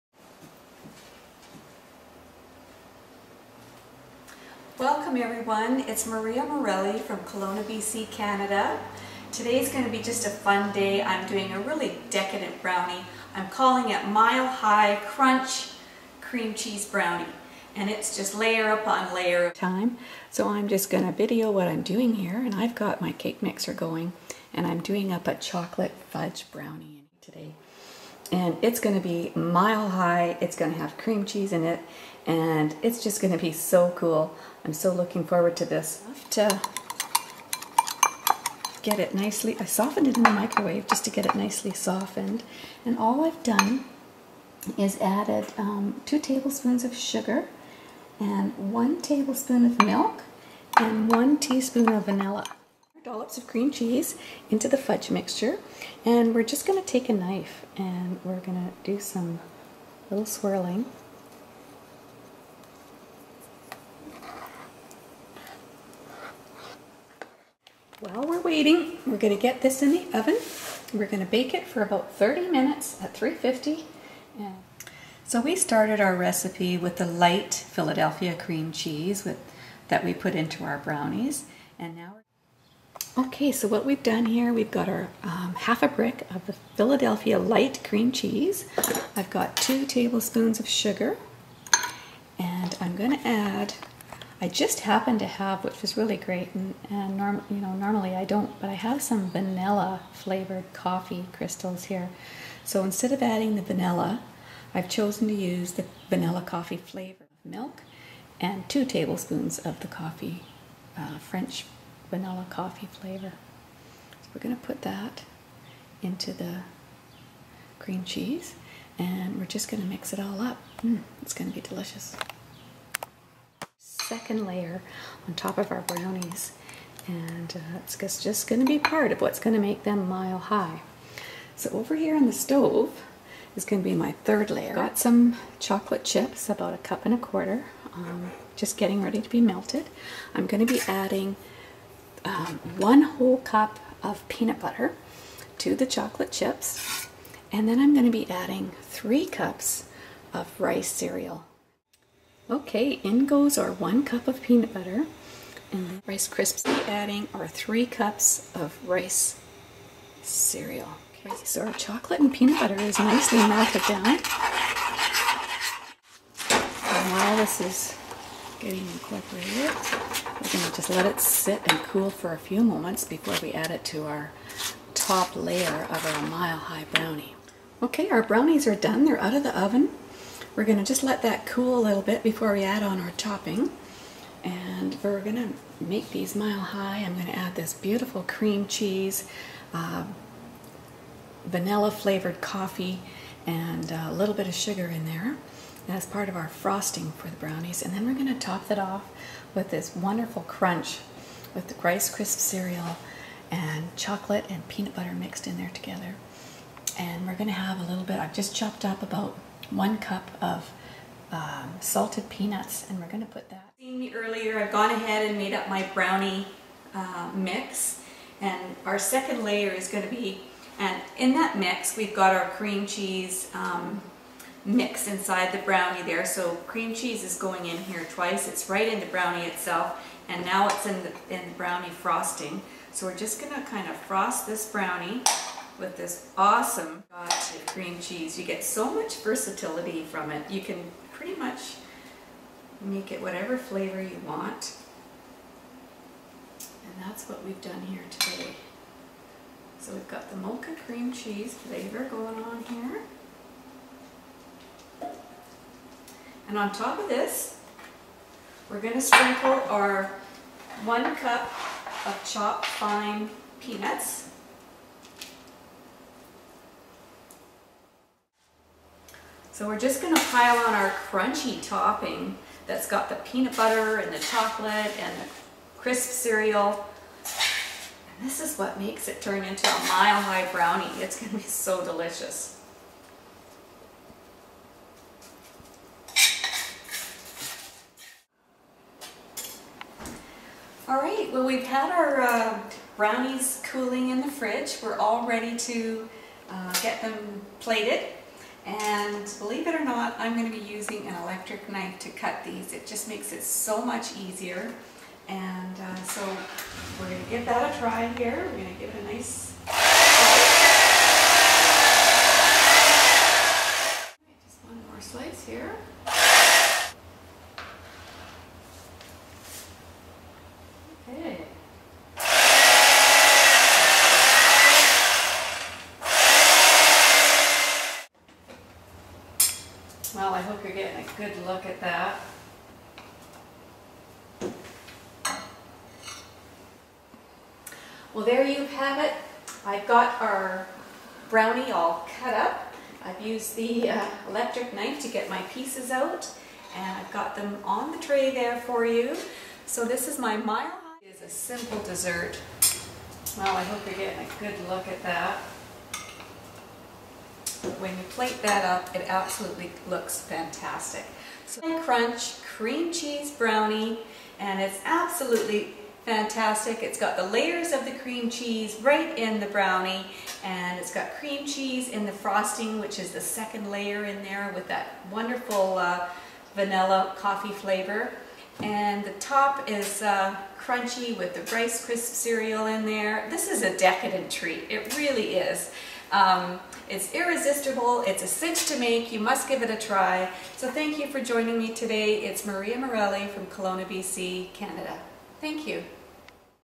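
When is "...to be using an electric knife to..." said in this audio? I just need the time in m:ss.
5:00.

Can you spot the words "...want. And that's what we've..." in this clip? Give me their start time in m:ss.
4:04.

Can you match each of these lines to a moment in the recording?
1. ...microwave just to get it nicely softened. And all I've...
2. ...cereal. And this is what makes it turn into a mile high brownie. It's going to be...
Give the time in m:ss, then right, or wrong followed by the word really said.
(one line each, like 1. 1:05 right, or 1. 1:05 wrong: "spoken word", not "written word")
1. 0:40 right
2. 4:36 right.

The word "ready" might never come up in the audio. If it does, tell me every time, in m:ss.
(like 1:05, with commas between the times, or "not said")
2:19, 4:55.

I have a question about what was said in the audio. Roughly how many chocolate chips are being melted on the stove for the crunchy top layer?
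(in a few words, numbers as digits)
A cup and a quarter.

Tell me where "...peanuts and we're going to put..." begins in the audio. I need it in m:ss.
3:32.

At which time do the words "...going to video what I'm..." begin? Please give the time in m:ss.
0:20.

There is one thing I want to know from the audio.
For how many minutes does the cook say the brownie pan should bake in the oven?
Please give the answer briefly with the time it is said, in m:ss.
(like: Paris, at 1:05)
30 minutes, at 1:12.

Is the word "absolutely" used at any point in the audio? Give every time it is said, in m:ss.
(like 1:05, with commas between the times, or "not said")
5:59, 6:04.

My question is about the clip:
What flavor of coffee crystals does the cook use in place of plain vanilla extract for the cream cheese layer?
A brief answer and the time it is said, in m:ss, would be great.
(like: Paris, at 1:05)
French vanilla, at 1:51.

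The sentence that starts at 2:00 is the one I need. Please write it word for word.
Mm, it's going to be delicious.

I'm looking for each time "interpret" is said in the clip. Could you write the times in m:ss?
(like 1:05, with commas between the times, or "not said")
not said.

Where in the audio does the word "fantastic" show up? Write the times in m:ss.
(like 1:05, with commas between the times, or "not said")
6:00, 6:06.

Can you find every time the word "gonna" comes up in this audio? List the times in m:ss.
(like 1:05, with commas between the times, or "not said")
1:32, 3:53.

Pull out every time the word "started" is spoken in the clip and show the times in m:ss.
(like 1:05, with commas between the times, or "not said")
1:15.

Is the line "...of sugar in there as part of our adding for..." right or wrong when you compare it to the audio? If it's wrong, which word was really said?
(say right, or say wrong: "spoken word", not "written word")
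wrong: "frosting", not "adding".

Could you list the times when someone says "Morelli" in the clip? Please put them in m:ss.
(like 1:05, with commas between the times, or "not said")
0:06, 6:32.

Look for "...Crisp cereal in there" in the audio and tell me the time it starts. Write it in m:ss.
6:21.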